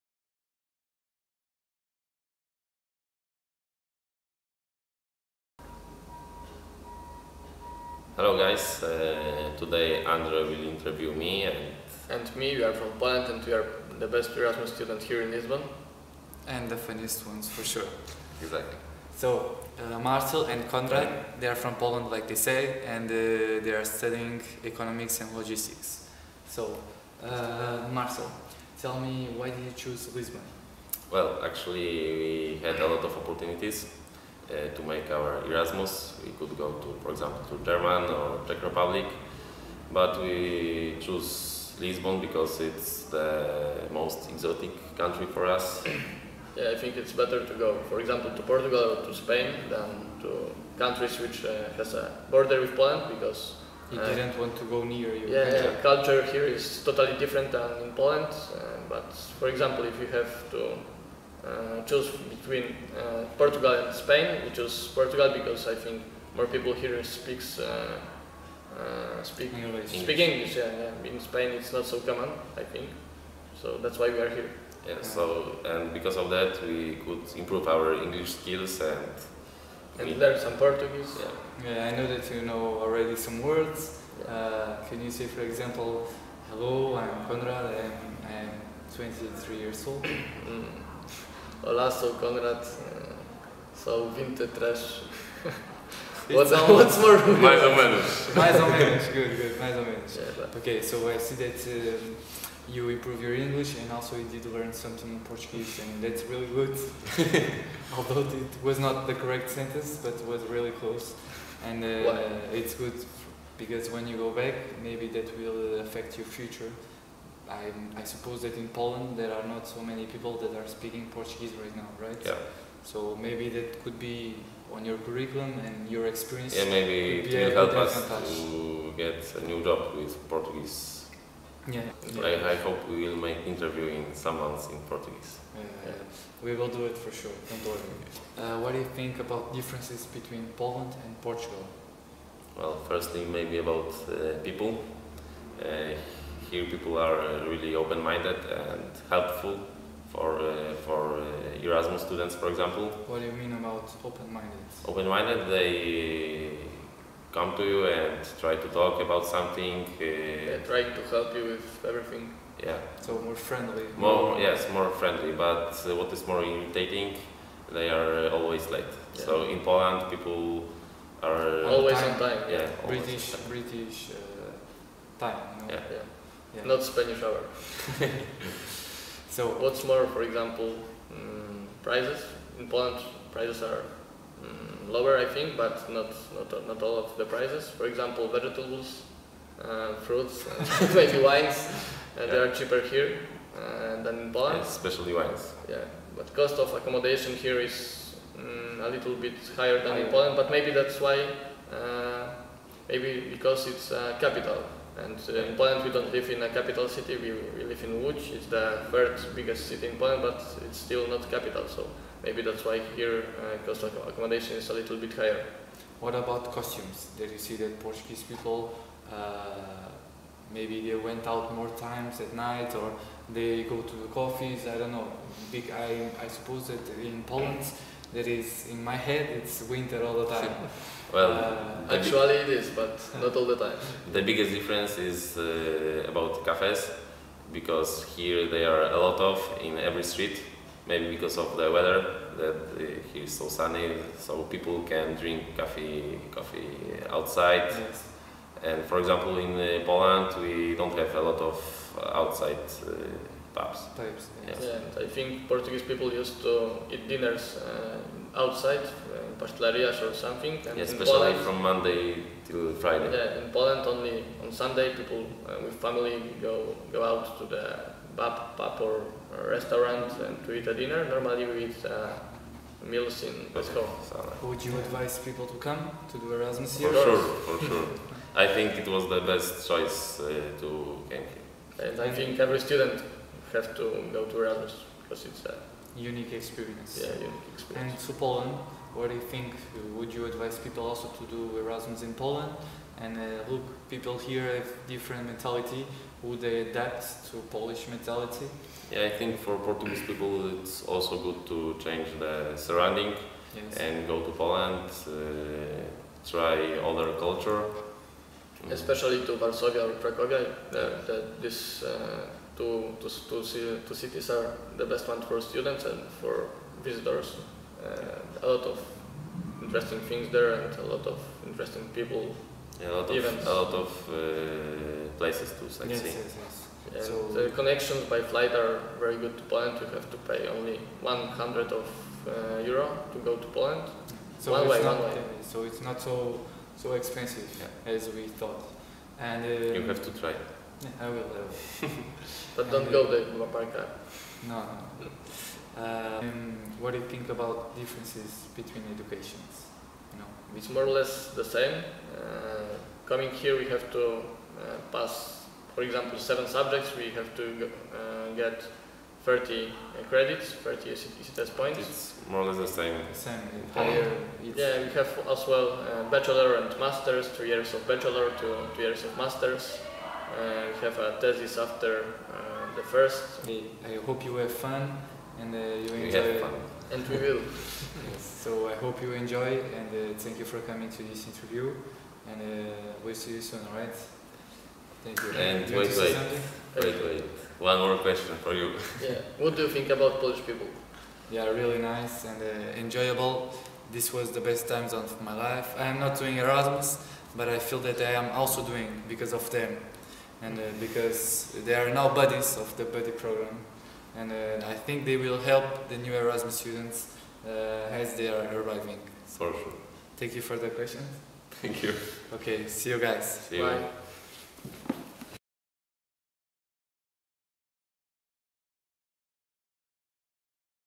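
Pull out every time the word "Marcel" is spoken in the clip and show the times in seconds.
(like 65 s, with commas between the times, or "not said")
19 s, 27 s.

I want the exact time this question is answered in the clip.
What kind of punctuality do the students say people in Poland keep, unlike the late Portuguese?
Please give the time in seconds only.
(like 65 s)
173 s.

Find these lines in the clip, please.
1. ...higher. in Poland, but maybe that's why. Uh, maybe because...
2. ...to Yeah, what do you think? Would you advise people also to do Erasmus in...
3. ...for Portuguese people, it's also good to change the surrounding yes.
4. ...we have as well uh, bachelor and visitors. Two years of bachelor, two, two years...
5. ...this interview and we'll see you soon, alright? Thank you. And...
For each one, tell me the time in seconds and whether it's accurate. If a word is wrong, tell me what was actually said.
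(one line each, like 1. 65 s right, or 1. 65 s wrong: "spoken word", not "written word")
1. 199 s right
2. 288 s wrong: "Poland", not "Yeah"
3. 299 s right
4. 364 s wrong: "masters", not "visitors"
5. 381 s right.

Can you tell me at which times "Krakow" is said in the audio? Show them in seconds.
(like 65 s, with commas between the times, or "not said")
309 s.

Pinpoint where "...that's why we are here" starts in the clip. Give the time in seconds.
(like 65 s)
73 s.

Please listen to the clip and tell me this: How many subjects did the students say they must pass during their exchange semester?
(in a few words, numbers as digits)
7.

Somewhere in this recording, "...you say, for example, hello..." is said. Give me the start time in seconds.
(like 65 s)
85 s.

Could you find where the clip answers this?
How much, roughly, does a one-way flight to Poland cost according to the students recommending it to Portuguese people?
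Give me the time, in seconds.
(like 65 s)
331 s.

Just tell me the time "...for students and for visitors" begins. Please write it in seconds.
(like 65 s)
315 s.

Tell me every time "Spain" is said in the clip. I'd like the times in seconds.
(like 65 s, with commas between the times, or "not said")
49 s, 63 s, 71 s.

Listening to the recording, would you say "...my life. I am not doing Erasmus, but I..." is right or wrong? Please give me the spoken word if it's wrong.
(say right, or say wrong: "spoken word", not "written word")
right.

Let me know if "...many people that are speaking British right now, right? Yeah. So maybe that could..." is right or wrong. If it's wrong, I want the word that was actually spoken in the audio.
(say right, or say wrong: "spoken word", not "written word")
wrong: "Portuguese", not "British".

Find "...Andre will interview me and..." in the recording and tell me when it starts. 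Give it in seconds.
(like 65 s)
10 s.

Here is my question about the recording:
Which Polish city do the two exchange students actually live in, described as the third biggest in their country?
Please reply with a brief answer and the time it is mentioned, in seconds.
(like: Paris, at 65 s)
Łódź, at 208 s.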